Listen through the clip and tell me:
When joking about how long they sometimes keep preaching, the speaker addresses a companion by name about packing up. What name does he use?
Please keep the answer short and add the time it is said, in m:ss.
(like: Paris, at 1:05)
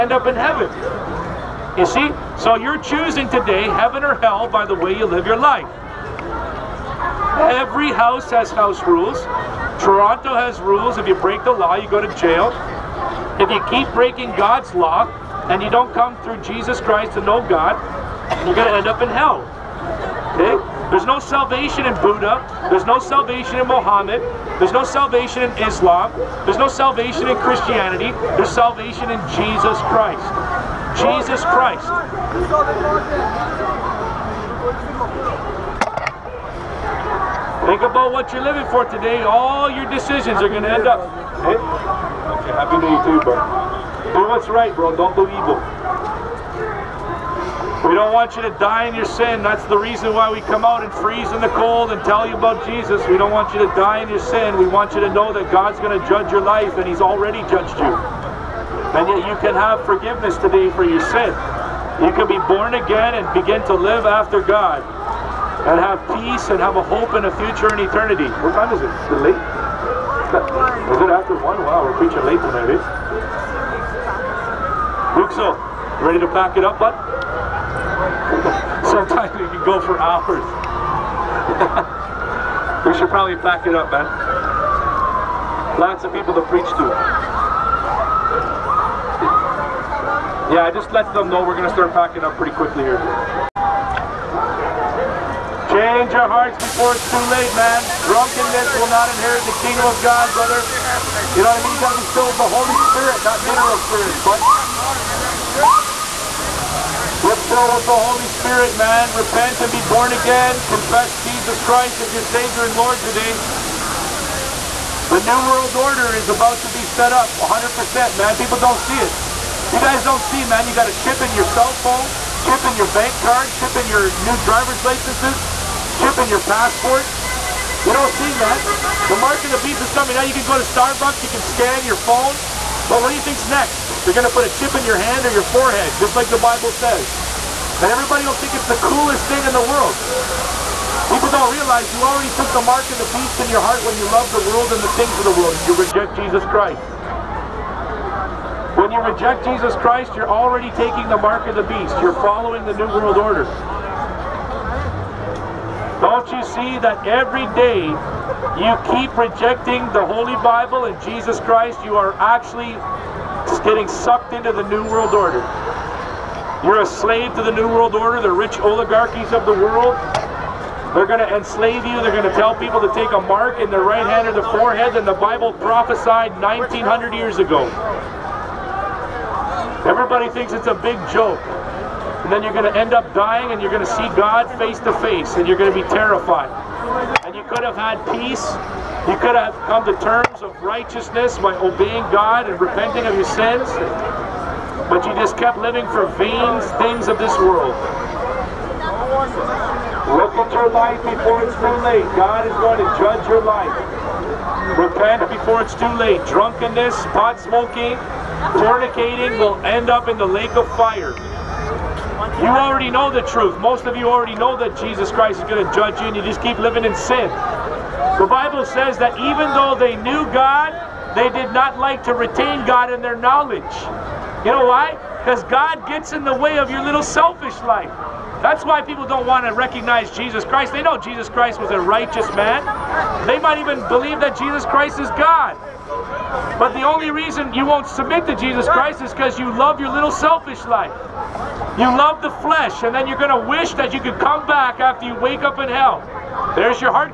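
Luxo, at 1:15.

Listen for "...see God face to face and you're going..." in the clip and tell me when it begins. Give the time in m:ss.
3:03.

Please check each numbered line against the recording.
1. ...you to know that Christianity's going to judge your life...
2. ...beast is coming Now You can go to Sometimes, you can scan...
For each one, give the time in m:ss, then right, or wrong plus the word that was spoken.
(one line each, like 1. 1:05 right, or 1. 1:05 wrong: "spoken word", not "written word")
1. 0:54 wrong: "God", not "Christianity"
2. 2:09 wrong: "Starbucks", not "Sometimes".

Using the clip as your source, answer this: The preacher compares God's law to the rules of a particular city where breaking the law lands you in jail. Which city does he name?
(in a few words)
Toronto.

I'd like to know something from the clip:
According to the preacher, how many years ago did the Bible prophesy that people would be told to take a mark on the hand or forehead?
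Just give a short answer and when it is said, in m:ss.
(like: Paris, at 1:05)
1900, at 2:56.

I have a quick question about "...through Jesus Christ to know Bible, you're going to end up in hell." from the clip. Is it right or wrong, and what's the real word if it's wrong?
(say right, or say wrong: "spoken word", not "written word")
wrong: "God", not "Bible".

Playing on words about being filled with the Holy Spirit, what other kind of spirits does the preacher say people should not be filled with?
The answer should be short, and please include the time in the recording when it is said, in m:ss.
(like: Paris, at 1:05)
mineral spirits, at 1:43.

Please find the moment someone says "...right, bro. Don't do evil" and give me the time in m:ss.
0:44.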